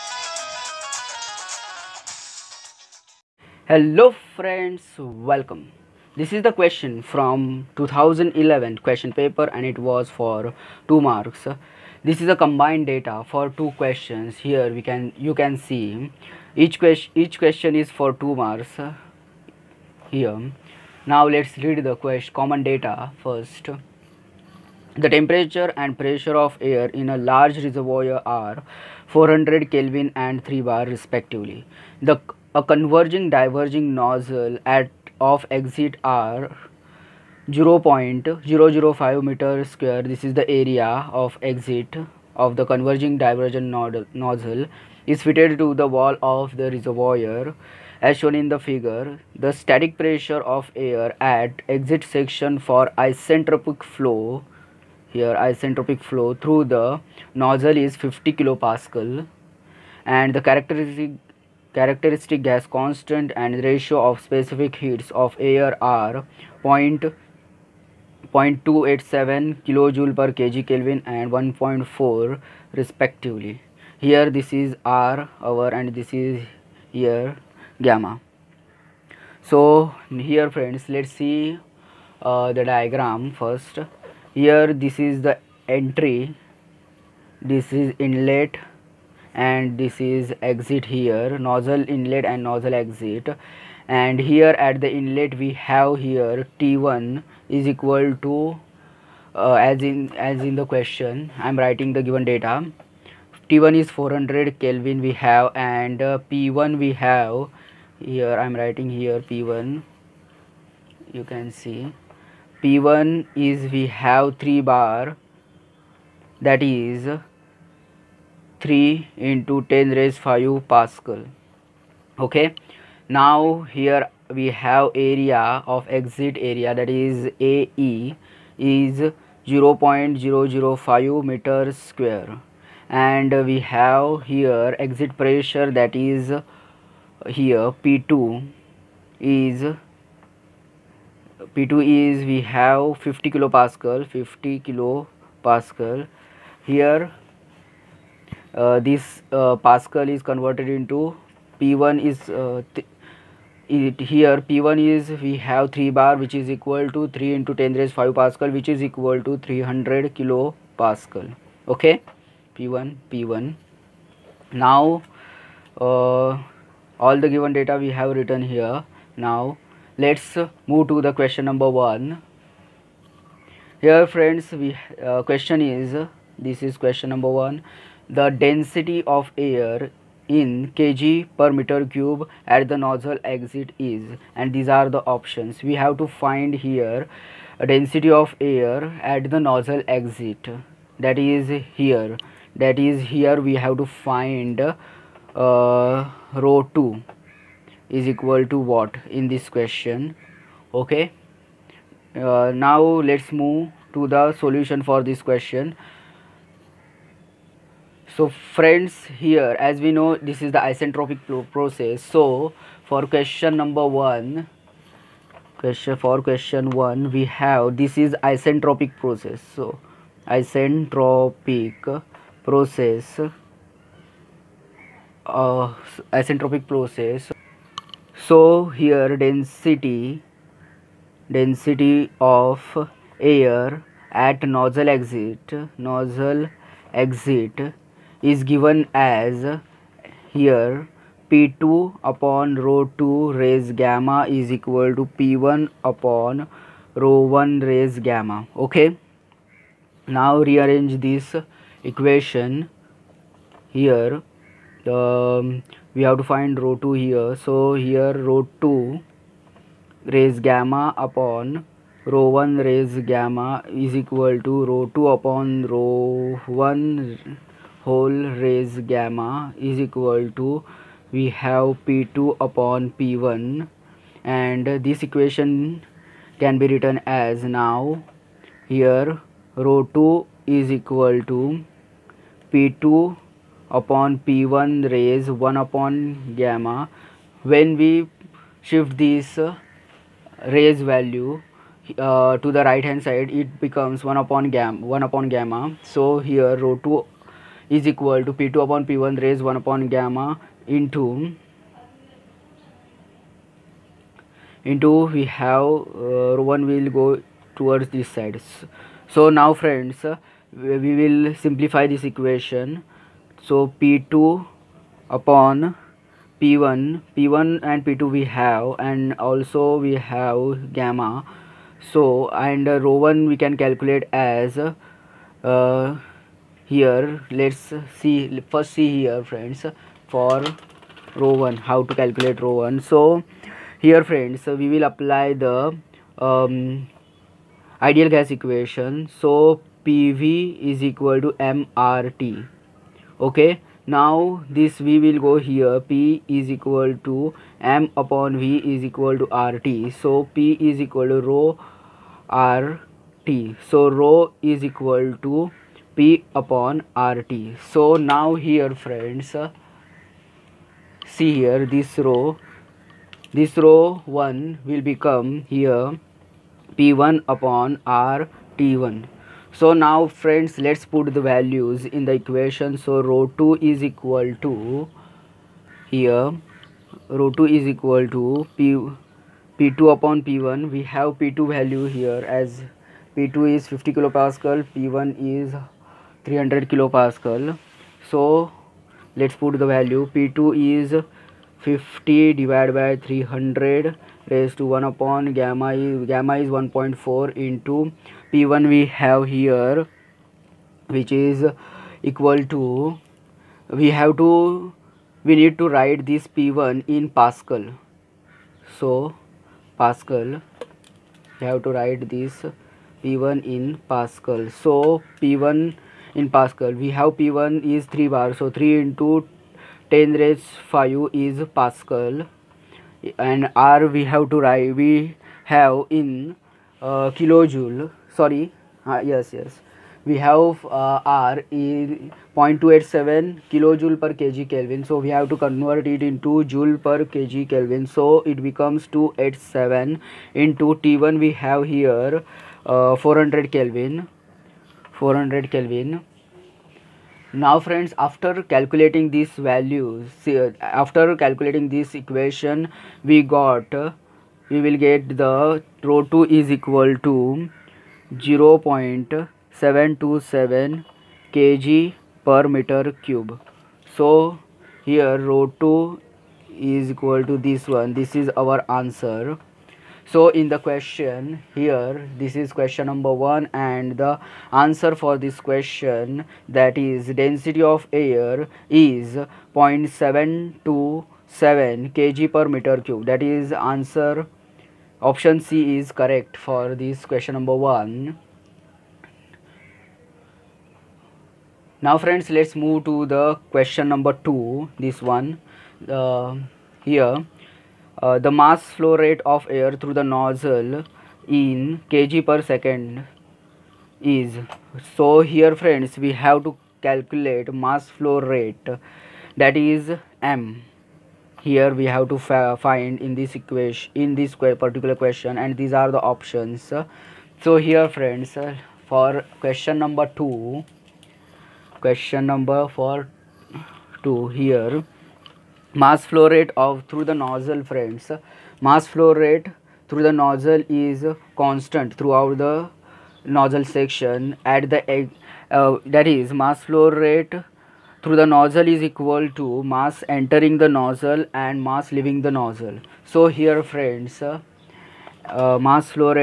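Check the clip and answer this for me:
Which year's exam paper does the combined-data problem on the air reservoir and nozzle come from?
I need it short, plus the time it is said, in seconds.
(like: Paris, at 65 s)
2011, at 7 s.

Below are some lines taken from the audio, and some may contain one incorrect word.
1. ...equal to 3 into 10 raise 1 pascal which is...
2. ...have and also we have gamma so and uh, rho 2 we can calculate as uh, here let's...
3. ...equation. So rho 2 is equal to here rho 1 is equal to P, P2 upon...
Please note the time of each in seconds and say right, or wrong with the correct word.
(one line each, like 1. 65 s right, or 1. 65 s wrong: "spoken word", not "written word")
1. 156 s wrong: "5", not "1"
2. 318 s wrong: "1", not "2"
3. 372 s wrong: "2", not "1".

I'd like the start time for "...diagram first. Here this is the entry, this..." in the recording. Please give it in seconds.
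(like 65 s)
82 s.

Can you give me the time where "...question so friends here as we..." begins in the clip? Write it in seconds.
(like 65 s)
205 s.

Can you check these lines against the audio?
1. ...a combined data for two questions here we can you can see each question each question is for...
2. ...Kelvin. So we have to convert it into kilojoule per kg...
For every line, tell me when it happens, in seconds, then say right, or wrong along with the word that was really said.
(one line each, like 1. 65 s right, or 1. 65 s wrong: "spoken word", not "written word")
1. 12 s right
2. 434 s wrong: "joule", not "kilojoule".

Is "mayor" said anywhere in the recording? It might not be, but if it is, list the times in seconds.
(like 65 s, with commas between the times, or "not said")
not said.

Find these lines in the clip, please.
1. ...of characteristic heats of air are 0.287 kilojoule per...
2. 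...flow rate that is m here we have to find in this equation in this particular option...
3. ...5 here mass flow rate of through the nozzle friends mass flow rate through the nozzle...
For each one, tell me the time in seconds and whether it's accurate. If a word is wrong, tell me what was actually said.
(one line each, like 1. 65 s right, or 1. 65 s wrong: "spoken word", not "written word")
1. 64 s wrong: "specific", not "characteristic"
2. 507 s wrong: "question", not "option"
3. 524 s wrong: "2", not "5".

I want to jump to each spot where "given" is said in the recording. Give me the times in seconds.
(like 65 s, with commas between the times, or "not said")
102 s, 167 s, 238 s.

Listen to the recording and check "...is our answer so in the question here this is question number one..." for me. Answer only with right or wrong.
right.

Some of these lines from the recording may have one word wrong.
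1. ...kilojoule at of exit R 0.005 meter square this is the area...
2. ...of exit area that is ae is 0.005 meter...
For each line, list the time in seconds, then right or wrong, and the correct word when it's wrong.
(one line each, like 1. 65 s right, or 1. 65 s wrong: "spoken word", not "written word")
1. 33 s wrong: "nozzle", not "kilojoule"
2. 125 s right.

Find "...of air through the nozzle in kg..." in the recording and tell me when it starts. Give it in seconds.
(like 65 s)
499 s.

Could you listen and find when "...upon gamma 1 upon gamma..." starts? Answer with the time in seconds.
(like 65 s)
294 s.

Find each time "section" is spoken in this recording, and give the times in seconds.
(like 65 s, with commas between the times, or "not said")
52 s, 533 s.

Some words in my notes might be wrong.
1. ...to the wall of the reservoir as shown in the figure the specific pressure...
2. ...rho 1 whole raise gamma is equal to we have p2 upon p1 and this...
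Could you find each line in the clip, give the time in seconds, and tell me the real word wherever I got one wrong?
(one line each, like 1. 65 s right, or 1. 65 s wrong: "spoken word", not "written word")
1. 45 s wrong: "static", not "specific"
2. 265 s right.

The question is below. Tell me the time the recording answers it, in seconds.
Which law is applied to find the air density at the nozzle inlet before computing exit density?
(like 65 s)
337 s.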